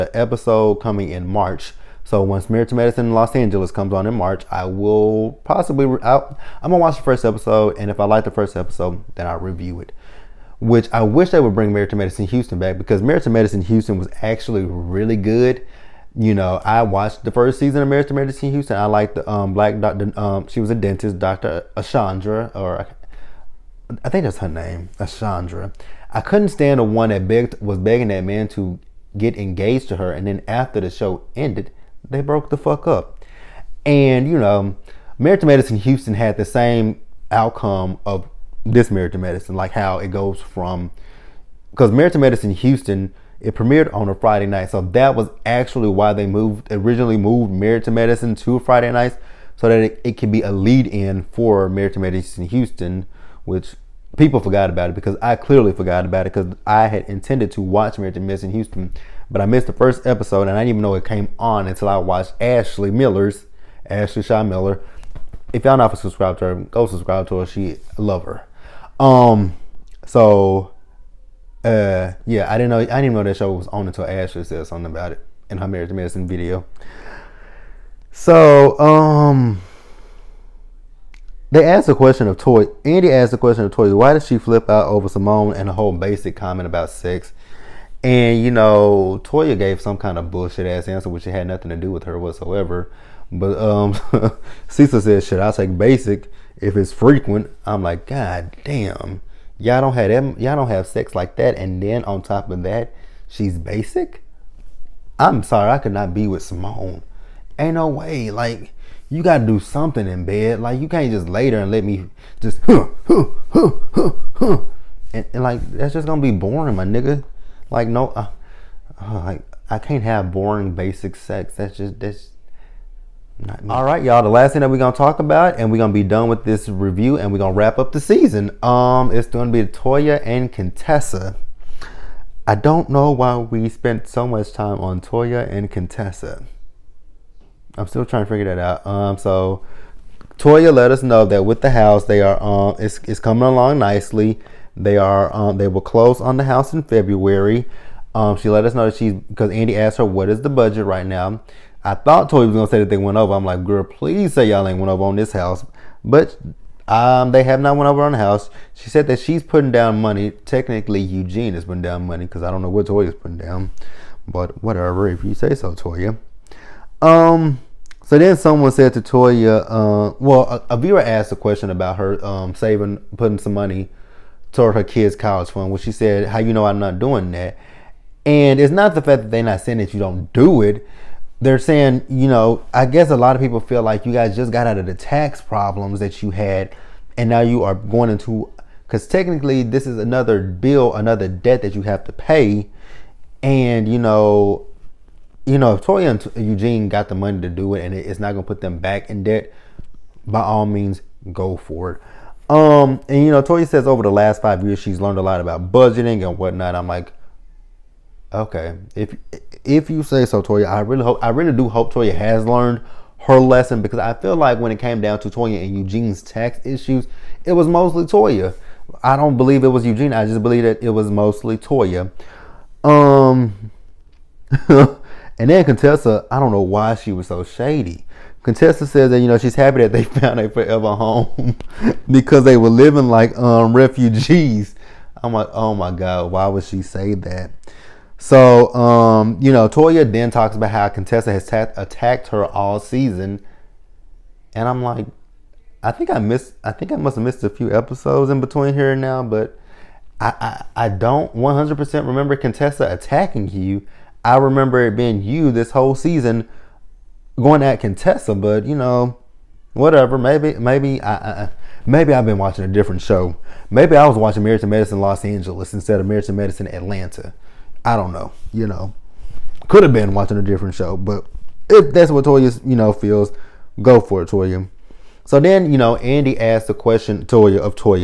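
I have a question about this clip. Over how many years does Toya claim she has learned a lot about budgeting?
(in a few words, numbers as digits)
5.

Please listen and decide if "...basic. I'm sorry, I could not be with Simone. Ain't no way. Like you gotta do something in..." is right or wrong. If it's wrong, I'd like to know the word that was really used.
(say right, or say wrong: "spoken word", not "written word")
right.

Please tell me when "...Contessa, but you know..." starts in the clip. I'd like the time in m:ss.
4:17.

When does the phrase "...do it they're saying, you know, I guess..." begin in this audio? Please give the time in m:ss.
3:00.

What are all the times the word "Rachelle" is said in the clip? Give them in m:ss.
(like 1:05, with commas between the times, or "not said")
not said.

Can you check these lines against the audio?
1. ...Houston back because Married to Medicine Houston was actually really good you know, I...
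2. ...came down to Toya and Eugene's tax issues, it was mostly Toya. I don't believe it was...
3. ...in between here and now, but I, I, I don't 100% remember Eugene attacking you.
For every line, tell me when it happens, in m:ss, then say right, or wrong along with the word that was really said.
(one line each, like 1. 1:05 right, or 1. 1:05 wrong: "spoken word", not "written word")
1. 0:12 right
2. 3:34 right
3. 4:08 wrong: "Contessa", not "Eugene".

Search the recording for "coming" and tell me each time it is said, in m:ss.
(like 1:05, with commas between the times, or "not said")
0:00, 2:23.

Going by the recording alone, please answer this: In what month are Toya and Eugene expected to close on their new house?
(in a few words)
February.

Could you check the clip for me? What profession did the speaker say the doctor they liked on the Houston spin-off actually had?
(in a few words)
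Dentist.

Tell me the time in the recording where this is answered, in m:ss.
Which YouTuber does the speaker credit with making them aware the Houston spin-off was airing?
1:03.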